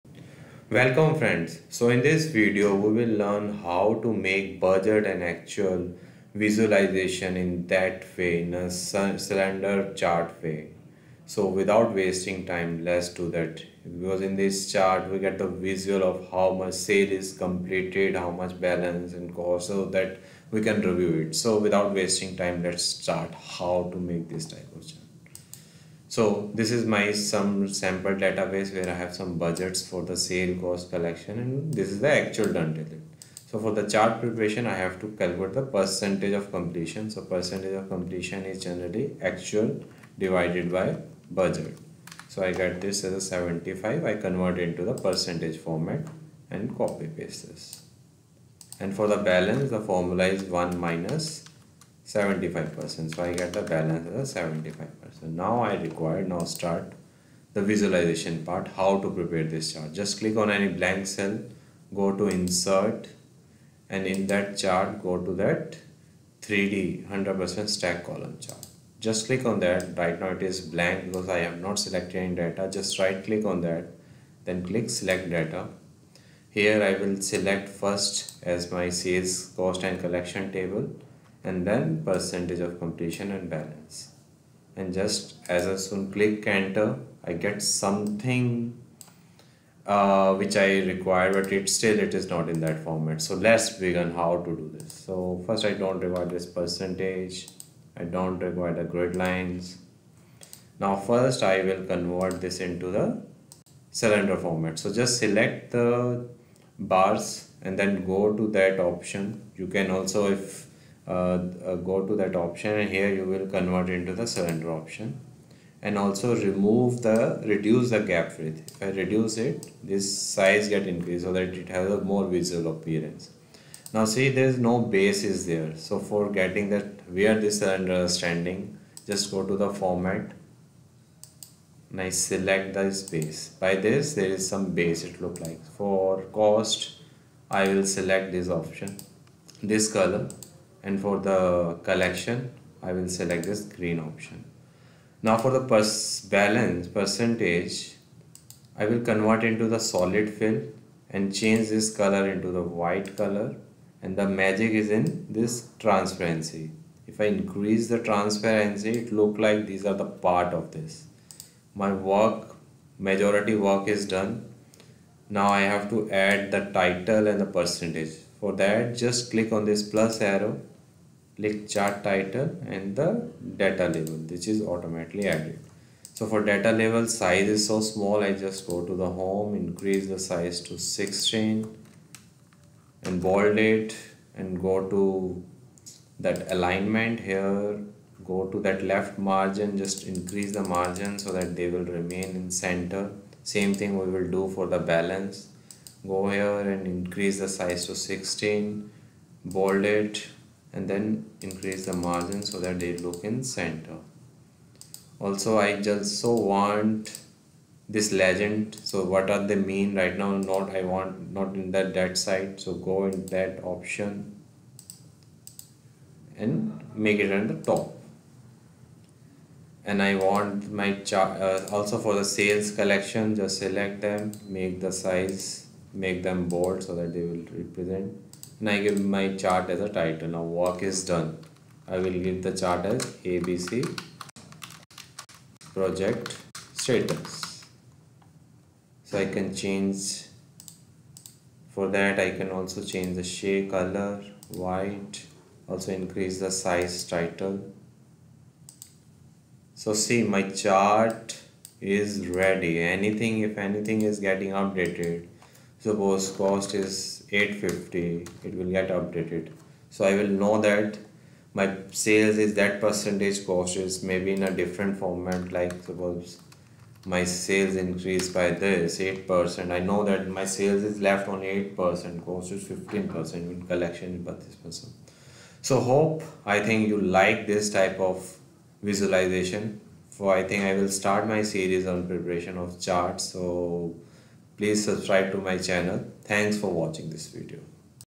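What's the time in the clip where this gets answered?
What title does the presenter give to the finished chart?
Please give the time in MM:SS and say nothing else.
03:53.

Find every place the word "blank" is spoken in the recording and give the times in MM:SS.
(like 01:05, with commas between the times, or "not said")
01:00, 01:10.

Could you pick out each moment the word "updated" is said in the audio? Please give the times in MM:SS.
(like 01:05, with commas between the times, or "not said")
04:14, 04:18.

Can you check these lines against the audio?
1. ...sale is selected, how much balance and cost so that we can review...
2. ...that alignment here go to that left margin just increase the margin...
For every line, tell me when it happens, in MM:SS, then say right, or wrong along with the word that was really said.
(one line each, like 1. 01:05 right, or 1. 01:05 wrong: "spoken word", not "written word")
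1. 00:16 wrong: "completed", not "selected"
2. 03:06 right.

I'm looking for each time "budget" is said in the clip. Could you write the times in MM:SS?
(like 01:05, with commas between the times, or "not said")
00:04, 00:29, 00:41.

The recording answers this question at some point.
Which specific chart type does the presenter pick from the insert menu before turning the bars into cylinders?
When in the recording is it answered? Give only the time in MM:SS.
01:06.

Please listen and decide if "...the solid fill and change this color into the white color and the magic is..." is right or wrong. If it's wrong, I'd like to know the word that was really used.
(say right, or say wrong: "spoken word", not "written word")
right.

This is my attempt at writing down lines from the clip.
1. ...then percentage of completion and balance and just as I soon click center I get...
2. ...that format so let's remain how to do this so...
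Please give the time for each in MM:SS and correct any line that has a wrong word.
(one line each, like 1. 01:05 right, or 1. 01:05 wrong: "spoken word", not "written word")
1. 01:21 wrong: "enter", not "center"
2. 01:32 wrong: "begin", not "remain".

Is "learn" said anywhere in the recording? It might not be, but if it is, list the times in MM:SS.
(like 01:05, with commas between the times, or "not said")
00:03.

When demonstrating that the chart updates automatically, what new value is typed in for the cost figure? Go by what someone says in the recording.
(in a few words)
850.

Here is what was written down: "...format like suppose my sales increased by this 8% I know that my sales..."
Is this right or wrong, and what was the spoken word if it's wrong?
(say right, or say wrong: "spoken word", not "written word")
right.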